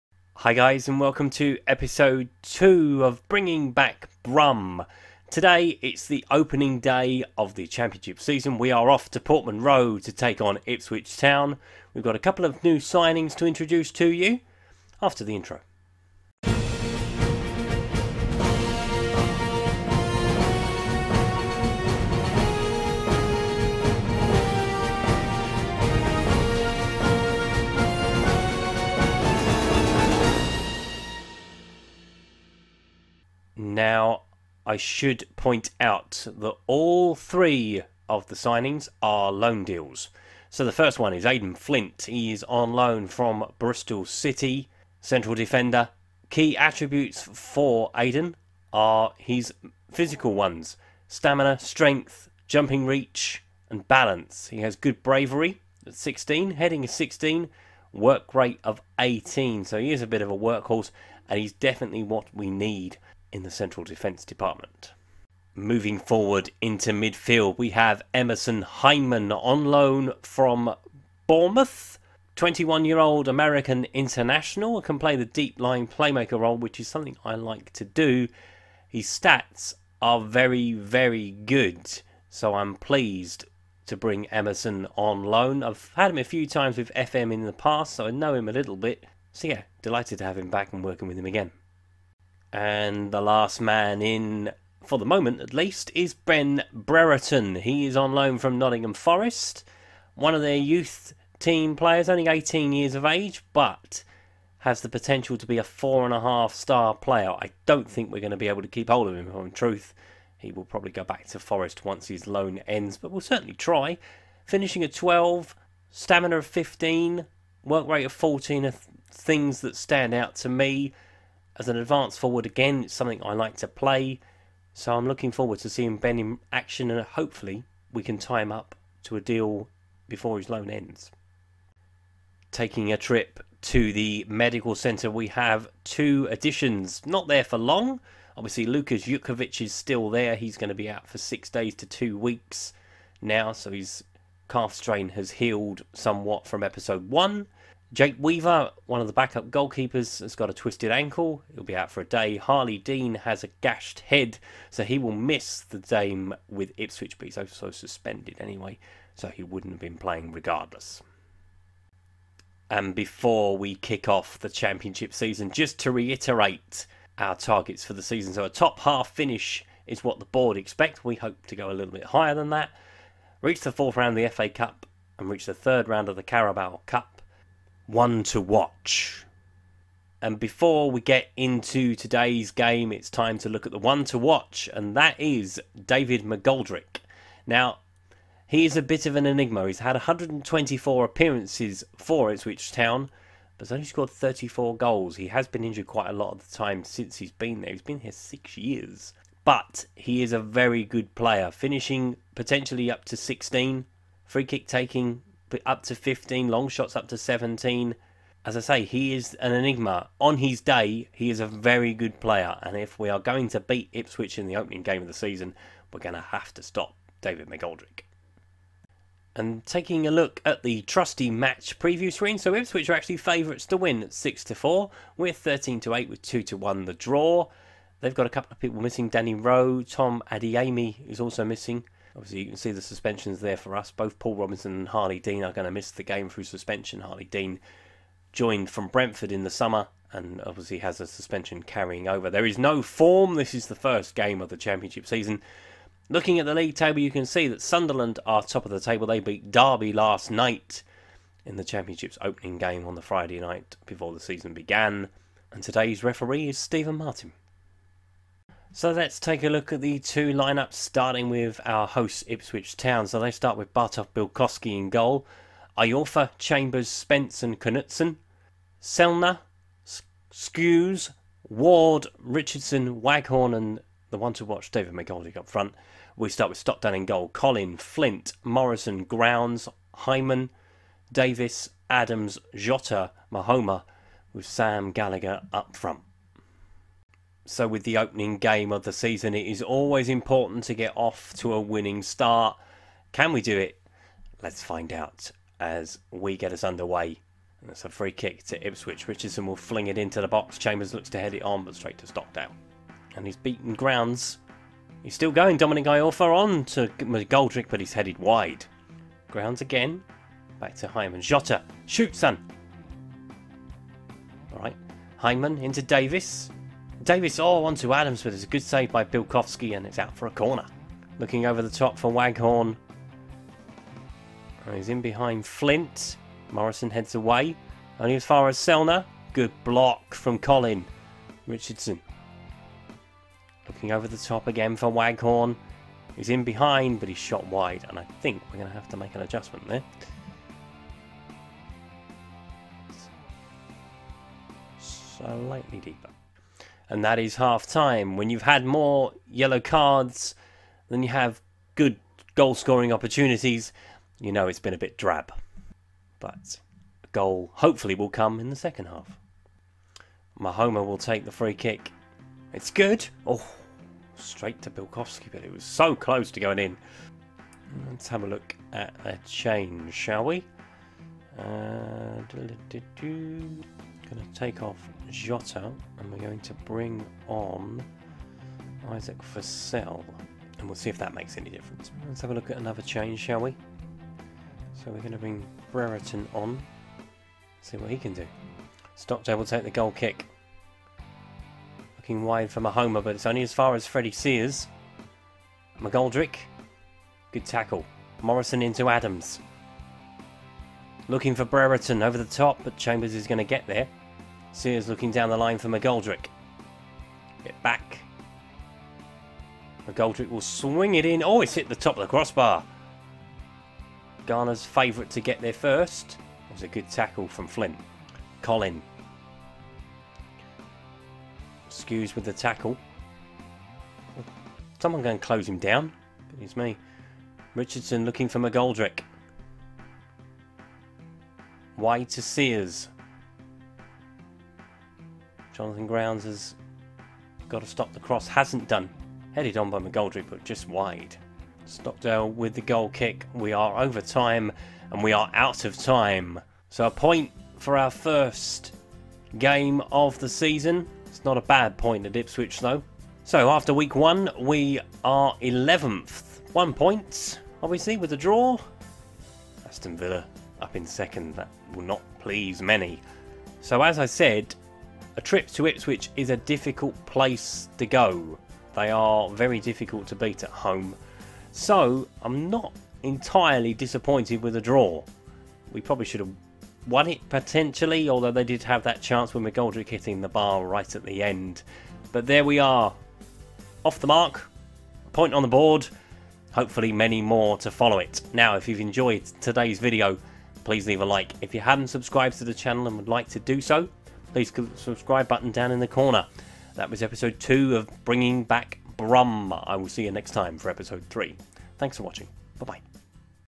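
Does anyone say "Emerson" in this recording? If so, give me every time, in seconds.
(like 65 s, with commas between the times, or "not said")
68 s, 84 s.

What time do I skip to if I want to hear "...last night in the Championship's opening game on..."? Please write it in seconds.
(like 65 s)
249 s.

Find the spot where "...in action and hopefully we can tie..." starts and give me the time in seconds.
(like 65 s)
126 s.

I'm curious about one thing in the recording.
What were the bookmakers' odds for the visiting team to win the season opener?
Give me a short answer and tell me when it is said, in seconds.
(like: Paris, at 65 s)
13 to 8, at 225 s.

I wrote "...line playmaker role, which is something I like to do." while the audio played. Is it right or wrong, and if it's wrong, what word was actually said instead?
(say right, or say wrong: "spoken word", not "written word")
right.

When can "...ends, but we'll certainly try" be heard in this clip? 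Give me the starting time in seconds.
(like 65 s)
112 s.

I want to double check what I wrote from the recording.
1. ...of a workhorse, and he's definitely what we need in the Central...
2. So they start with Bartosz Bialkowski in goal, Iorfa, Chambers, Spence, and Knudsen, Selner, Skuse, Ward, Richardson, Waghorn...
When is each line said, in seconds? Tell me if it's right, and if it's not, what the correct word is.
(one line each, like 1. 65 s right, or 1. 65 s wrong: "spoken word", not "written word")
1. 60 s right
2. 263 s right.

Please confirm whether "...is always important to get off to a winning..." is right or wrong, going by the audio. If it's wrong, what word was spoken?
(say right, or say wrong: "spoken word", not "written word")
right.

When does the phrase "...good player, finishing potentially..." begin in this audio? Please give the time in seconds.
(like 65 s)
200 s.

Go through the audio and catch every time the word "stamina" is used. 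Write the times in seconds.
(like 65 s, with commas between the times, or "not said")
51 s, 115 s.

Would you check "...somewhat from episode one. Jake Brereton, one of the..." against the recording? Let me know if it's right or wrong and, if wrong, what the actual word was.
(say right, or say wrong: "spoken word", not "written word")
wrong: "Weaver", not "Brereton".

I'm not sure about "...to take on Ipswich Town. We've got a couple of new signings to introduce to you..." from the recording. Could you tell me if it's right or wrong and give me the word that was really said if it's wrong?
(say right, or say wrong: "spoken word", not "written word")
right.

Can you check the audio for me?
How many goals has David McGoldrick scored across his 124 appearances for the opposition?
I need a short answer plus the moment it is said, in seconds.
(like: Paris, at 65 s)
34, at 194 s.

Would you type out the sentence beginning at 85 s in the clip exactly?
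I've had him a few times with FM in the past, so I know him a little bit.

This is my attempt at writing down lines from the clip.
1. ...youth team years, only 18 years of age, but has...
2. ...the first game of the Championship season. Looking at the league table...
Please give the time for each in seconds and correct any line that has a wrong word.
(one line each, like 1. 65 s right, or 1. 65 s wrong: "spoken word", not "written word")
1. 100 s wrong: "players", not "years"
2. 243 s right.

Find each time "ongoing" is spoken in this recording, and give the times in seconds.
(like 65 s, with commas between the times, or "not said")
not said.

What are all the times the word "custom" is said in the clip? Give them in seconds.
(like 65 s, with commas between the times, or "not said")
not said.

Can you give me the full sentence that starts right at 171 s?
We hope to go a little bit higher than that.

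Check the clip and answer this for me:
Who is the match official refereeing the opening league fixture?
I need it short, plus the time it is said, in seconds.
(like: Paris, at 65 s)
Stephen Martin, at 256 s.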